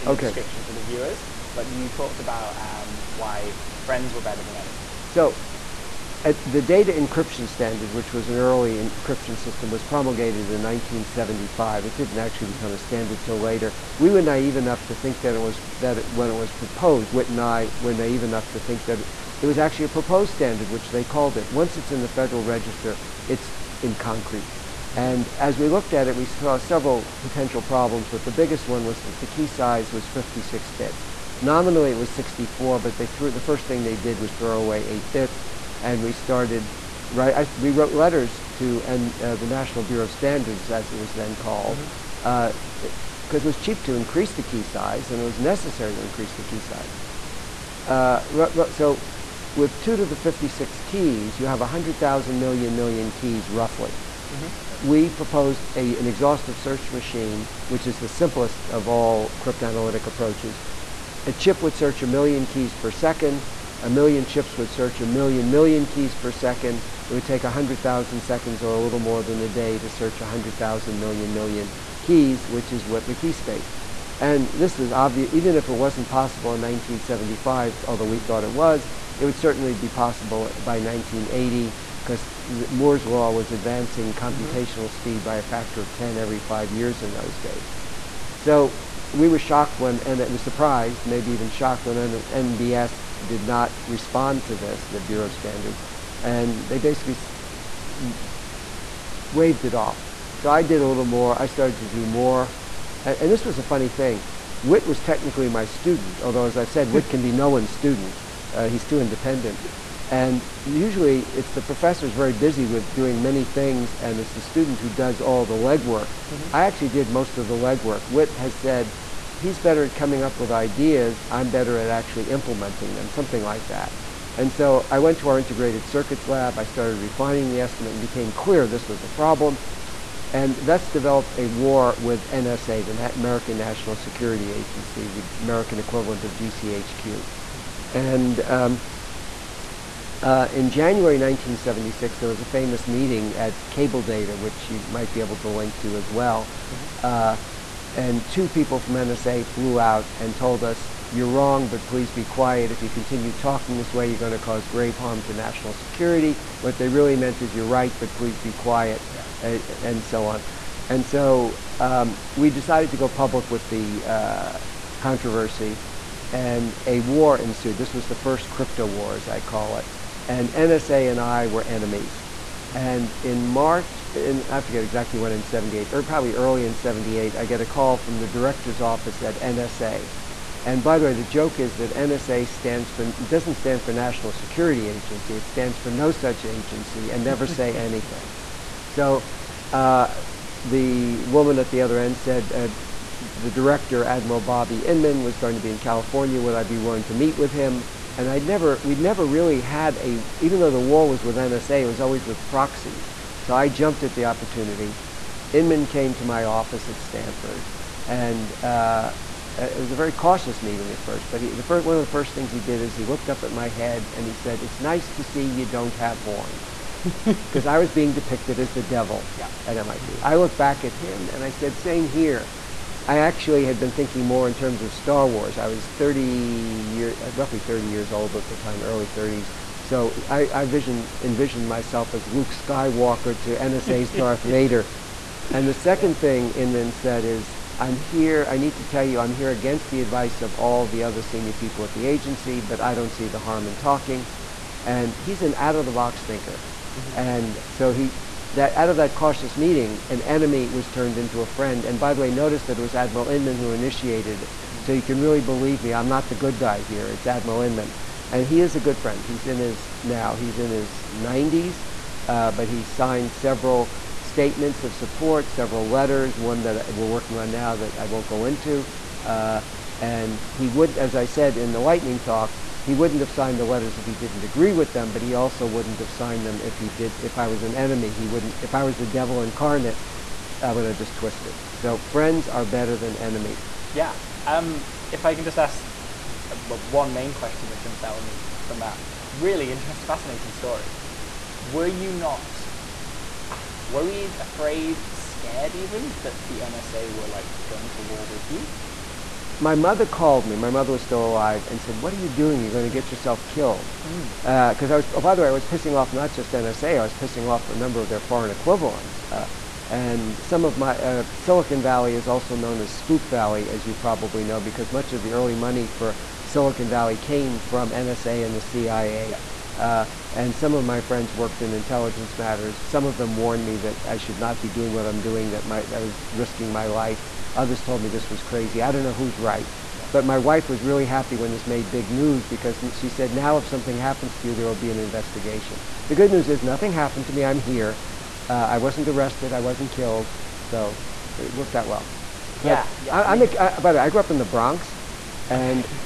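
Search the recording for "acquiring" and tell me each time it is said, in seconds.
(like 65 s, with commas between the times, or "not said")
not said.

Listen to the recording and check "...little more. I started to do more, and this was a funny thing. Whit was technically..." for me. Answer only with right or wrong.
right.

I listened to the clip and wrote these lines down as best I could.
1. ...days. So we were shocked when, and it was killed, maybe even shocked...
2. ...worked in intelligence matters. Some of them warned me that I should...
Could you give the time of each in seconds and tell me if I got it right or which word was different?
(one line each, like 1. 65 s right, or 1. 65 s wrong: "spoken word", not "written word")
1. 87 s wrong: "surprised", not "killed"
2. 321 s right.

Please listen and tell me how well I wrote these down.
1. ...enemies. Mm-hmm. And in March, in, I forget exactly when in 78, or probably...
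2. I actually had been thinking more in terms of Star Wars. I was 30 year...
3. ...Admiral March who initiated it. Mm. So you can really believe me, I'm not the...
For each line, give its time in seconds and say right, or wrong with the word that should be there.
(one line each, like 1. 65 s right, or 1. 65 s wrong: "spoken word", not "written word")
1. 171 s right
2. 223 s right
3. 252 s wrong: "Inman", not "March".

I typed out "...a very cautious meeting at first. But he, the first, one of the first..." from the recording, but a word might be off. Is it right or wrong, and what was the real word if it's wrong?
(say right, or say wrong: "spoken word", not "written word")
right.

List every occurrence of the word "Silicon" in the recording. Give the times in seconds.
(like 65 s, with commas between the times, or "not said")
311 s, 316 s.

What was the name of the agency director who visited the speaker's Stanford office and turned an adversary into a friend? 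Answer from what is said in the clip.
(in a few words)
Bobby Inman.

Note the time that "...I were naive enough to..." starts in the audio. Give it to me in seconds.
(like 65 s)
17 s.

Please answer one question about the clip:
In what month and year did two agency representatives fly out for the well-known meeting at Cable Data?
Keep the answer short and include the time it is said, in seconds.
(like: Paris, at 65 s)
January 1976, at 140 s.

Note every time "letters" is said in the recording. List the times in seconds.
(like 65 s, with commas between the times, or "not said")
37 s, 265 s, 273 s.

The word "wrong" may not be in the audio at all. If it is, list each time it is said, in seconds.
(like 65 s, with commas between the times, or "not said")
151 s.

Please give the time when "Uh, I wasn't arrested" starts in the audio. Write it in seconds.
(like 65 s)
338 s.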